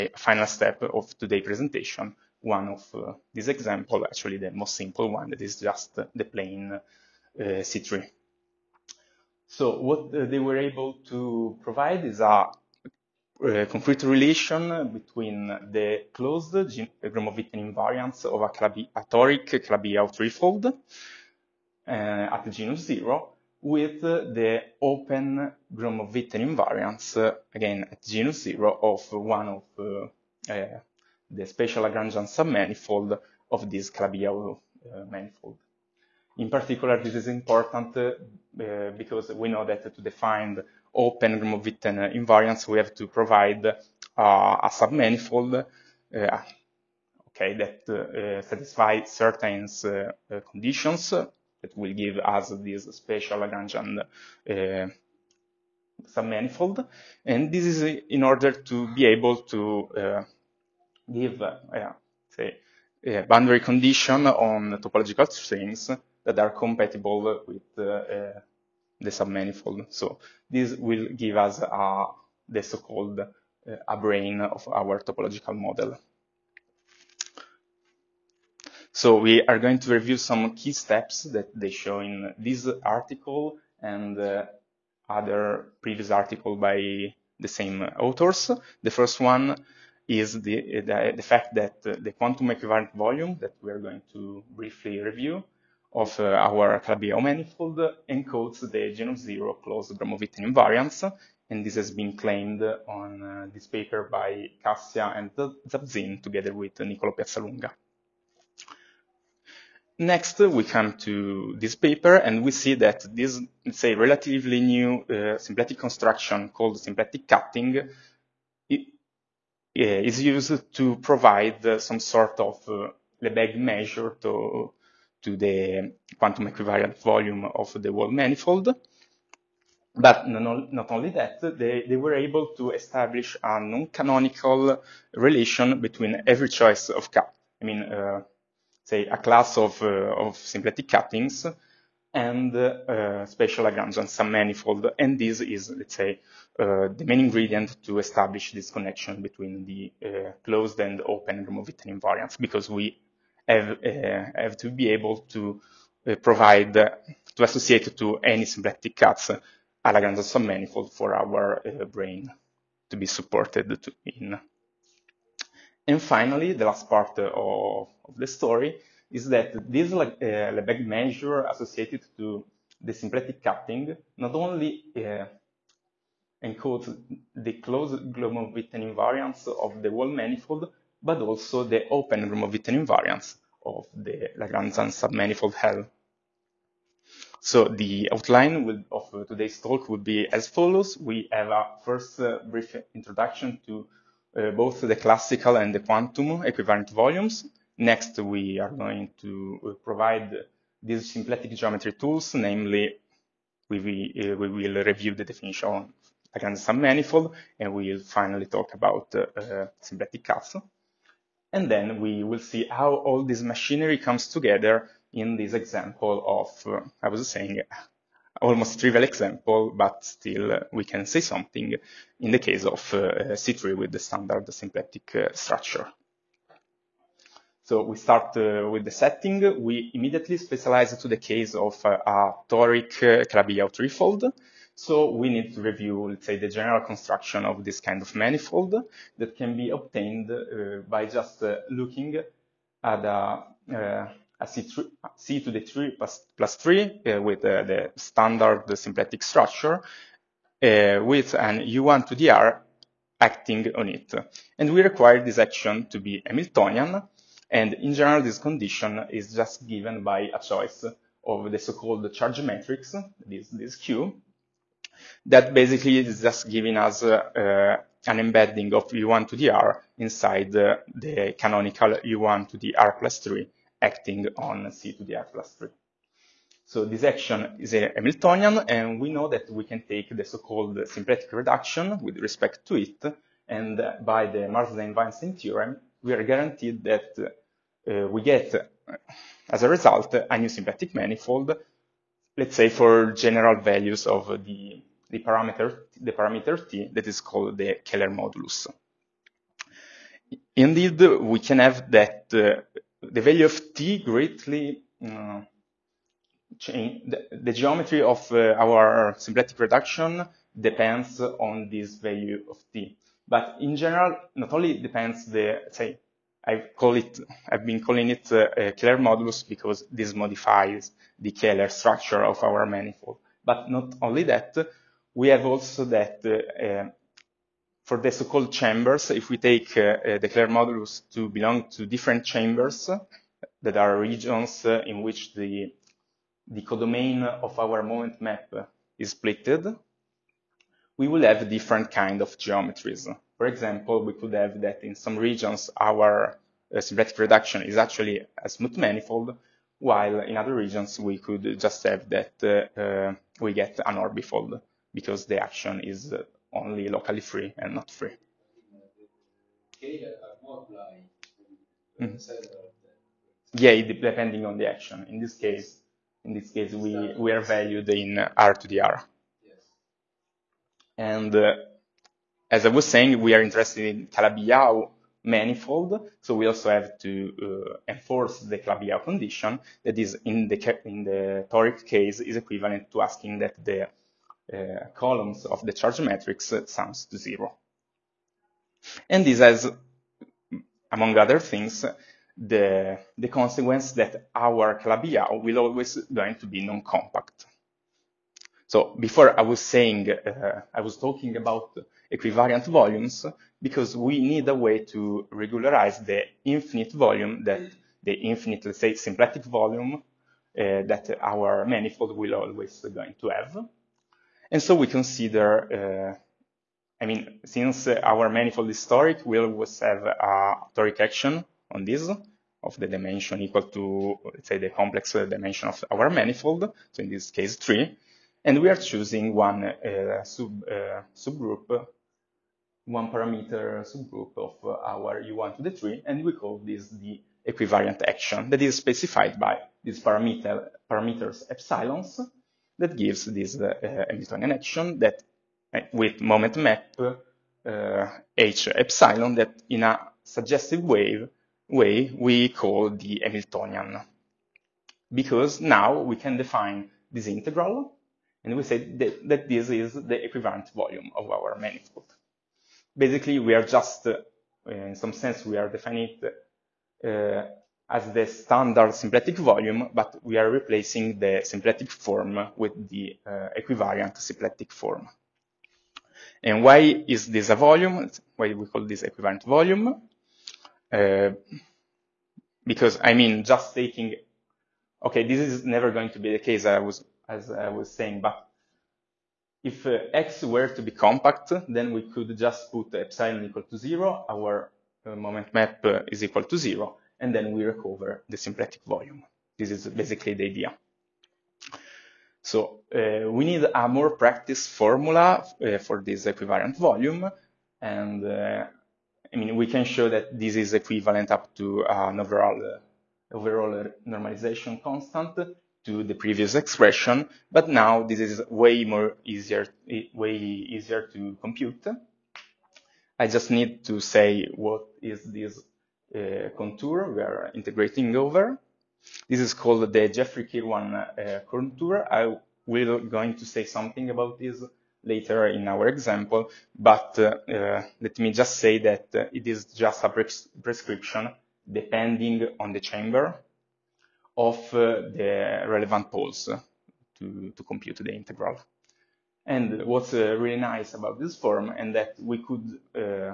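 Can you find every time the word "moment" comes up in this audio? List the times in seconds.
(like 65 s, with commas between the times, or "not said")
337 s, 446 s, 495 s.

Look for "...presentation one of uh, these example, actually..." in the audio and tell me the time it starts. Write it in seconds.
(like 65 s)
1 s.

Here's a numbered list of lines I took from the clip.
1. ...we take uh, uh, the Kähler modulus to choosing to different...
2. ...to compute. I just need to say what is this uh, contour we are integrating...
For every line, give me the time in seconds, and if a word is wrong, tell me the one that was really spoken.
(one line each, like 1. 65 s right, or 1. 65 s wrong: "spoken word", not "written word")
1. 329 s wrong: "belong", not "choosing"
2. 521 s right.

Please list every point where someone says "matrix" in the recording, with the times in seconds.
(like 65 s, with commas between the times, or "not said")
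262 s, 386 s.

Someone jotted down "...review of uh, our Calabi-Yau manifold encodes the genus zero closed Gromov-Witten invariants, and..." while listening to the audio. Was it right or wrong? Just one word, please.
right.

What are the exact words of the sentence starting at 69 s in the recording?
So this will give us uh, the so-called uh, a brane of our topological model.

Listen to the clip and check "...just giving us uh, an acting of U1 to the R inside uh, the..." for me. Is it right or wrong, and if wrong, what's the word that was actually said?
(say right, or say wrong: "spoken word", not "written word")
wrong: "embedding", not "acting".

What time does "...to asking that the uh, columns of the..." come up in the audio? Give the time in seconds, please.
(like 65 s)
382 s.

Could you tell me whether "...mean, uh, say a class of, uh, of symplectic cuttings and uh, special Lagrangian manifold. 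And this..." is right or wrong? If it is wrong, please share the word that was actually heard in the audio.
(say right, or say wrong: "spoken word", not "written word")
wrong: "submanifold", not "manifold".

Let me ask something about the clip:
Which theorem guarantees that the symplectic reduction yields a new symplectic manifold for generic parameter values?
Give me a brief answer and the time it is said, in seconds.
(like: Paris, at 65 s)
Marsden-Weinstein theorem, at 284 s.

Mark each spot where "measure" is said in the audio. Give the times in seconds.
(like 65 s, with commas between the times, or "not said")
123 s, 170 s.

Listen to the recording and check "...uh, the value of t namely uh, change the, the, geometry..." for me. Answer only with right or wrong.
wrong.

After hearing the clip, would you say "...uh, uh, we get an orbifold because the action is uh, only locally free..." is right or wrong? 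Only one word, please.
right.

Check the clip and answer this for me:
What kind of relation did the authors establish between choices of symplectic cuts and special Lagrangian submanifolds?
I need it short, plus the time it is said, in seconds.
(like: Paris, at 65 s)
non-canonical, at 133 s.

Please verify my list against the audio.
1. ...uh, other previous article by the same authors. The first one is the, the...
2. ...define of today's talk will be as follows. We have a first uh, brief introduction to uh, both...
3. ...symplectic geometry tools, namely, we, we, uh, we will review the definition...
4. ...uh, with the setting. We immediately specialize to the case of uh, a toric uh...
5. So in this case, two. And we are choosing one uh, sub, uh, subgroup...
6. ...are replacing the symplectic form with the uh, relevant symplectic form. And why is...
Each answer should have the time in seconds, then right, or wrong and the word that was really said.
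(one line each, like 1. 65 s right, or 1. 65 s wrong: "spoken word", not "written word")
1. 84 s right
2. 188 s wrong: "outline", not "define"
3. 201 s right
4. 228 s right
5. 426 s wrong: "three", not "two"
6. 470 s wrong: "equivariant", not "relevant".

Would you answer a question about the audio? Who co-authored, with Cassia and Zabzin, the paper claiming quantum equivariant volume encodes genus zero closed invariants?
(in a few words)
Nicolo Piazzalunga.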